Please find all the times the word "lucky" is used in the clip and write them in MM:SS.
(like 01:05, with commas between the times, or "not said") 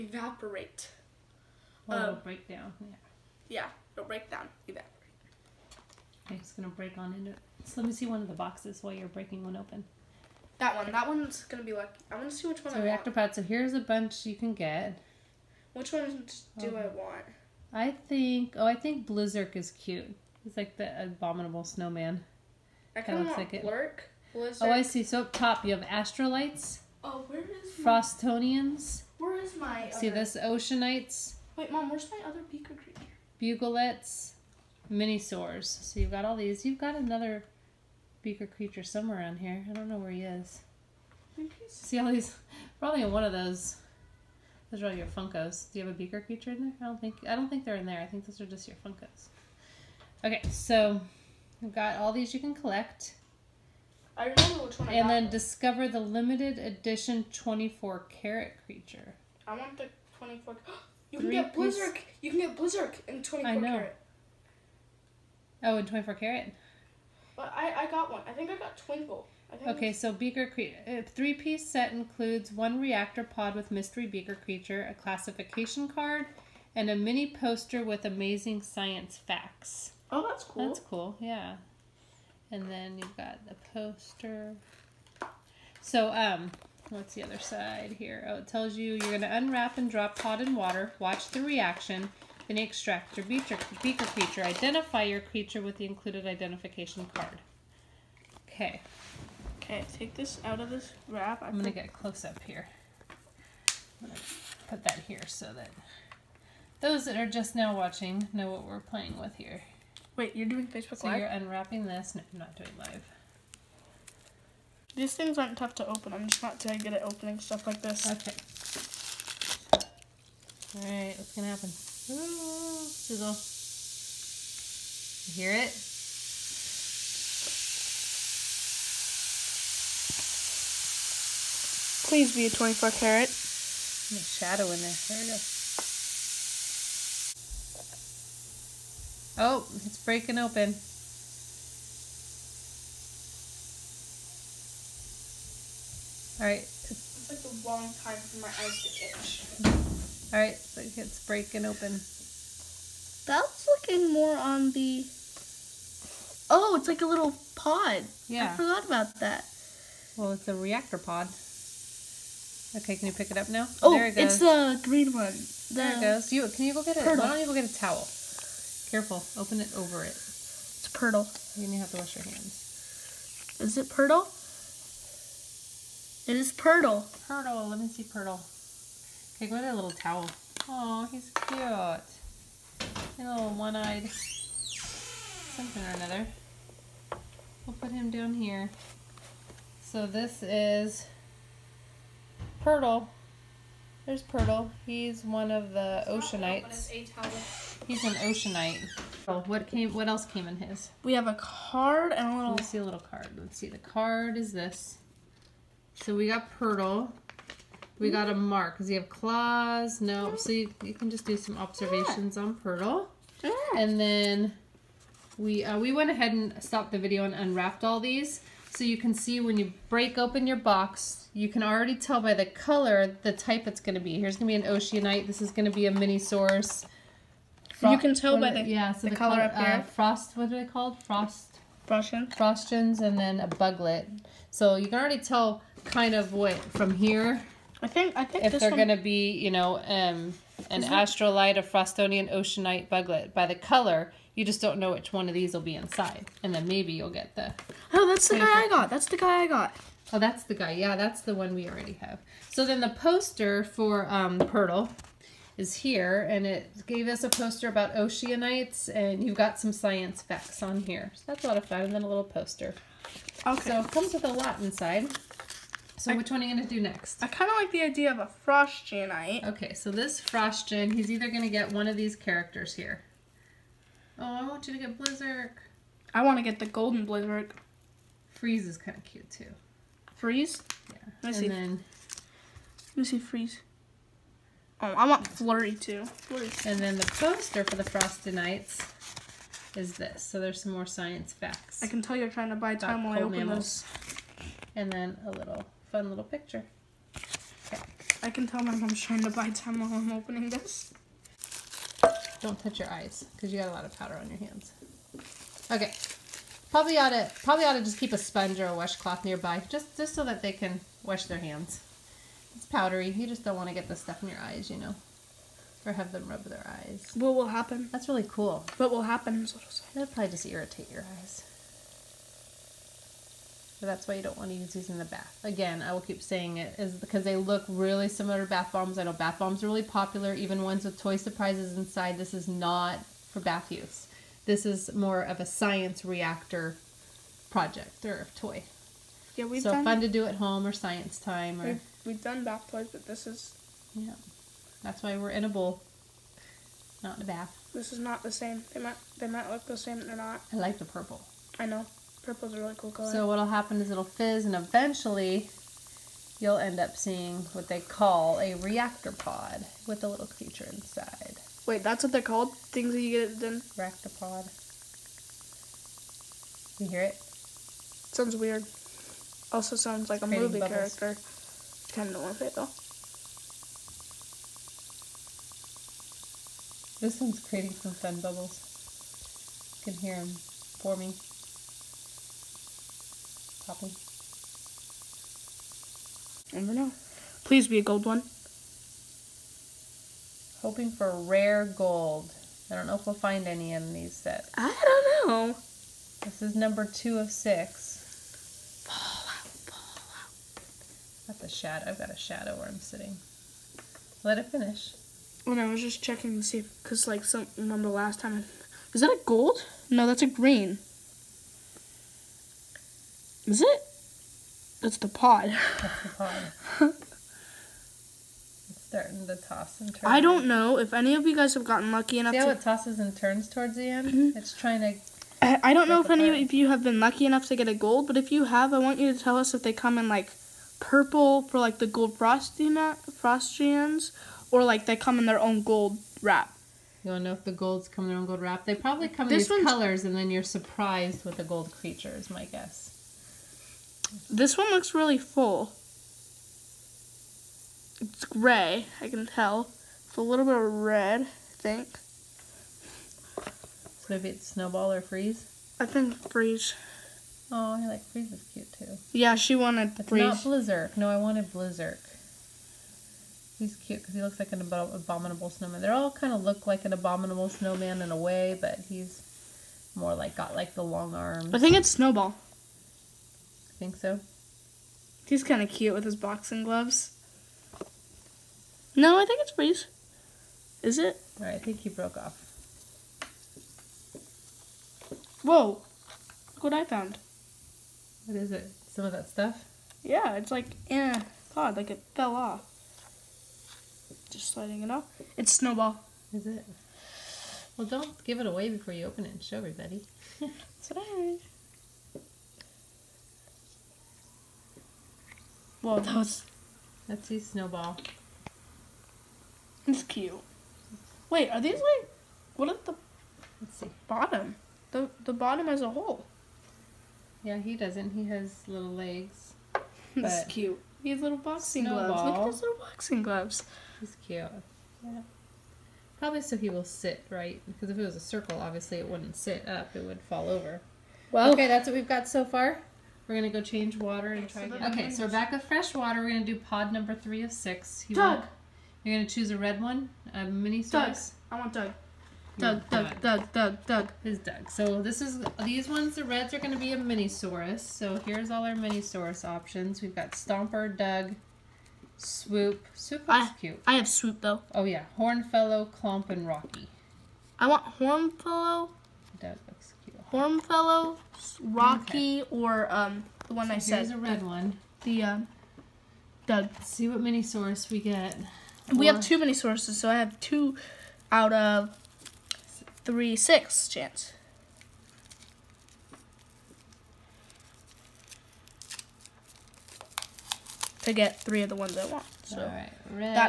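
00:11, 07:01, 07:06.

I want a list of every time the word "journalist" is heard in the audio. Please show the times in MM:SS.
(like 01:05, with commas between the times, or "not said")
not said.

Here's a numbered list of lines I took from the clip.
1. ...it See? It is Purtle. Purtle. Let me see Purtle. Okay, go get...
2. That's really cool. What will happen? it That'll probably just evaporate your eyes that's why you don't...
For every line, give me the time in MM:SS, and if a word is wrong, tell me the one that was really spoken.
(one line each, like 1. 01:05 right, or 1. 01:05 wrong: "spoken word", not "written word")
1. 02:53 wrong: "Purtle", not "See"
2. 05:17 wrong: "irritate", not "evaporate".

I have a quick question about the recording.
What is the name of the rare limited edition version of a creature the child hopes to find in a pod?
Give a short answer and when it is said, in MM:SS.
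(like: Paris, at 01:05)
24 carat creature, at 00:57.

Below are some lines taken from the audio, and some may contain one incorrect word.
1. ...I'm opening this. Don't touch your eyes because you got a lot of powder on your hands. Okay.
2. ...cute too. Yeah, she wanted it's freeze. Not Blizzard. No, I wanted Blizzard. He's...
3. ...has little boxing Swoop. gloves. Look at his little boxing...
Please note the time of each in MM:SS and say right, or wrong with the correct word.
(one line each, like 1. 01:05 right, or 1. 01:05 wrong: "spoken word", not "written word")
1. 04:59 right
2. 07:38 right
3. 08:41 wrong: "Snowball", not "Swoop".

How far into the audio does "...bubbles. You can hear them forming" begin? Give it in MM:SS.
06:18.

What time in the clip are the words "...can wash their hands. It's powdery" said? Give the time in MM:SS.
05:10.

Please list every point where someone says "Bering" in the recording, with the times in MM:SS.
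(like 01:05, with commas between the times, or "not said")
not said.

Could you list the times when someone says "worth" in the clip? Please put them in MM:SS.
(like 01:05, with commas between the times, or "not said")
06:12.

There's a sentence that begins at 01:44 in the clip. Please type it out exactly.
put that here so that those that are just now watching know what we're playing with here.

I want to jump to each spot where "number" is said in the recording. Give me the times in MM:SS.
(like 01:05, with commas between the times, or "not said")
06:36, 08:56.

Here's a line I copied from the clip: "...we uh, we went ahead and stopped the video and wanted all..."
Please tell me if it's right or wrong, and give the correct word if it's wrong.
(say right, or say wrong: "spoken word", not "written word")
wrong: "unwrapped", not "wanted".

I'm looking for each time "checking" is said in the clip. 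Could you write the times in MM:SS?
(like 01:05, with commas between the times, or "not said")
06:46.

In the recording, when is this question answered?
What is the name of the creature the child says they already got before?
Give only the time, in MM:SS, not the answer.
01:08.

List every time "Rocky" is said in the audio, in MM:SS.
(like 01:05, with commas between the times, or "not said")
09:16, 09:21.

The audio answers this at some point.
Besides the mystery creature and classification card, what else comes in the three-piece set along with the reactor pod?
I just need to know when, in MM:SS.
01:16.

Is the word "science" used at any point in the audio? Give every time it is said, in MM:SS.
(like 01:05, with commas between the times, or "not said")
01:18, 04:19, 04:50, 05:35, 05:40.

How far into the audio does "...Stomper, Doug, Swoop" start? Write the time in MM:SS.
09:10.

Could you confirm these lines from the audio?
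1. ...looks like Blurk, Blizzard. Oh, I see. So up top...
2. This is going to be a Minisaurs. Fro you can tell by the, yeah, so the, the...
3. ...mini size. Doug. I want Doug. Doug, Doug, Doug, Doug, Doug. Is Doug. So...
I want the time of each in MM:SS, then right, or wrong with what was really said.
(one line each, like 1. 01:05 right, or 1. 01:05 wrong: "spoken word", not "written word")
1. 00:23 right
2. 03:45 right
3. 09:00 right.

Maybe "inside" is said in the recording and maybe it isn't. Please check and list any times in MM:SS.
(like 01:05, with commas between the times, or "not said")
04:05, 04:24, 05:31, 06:00.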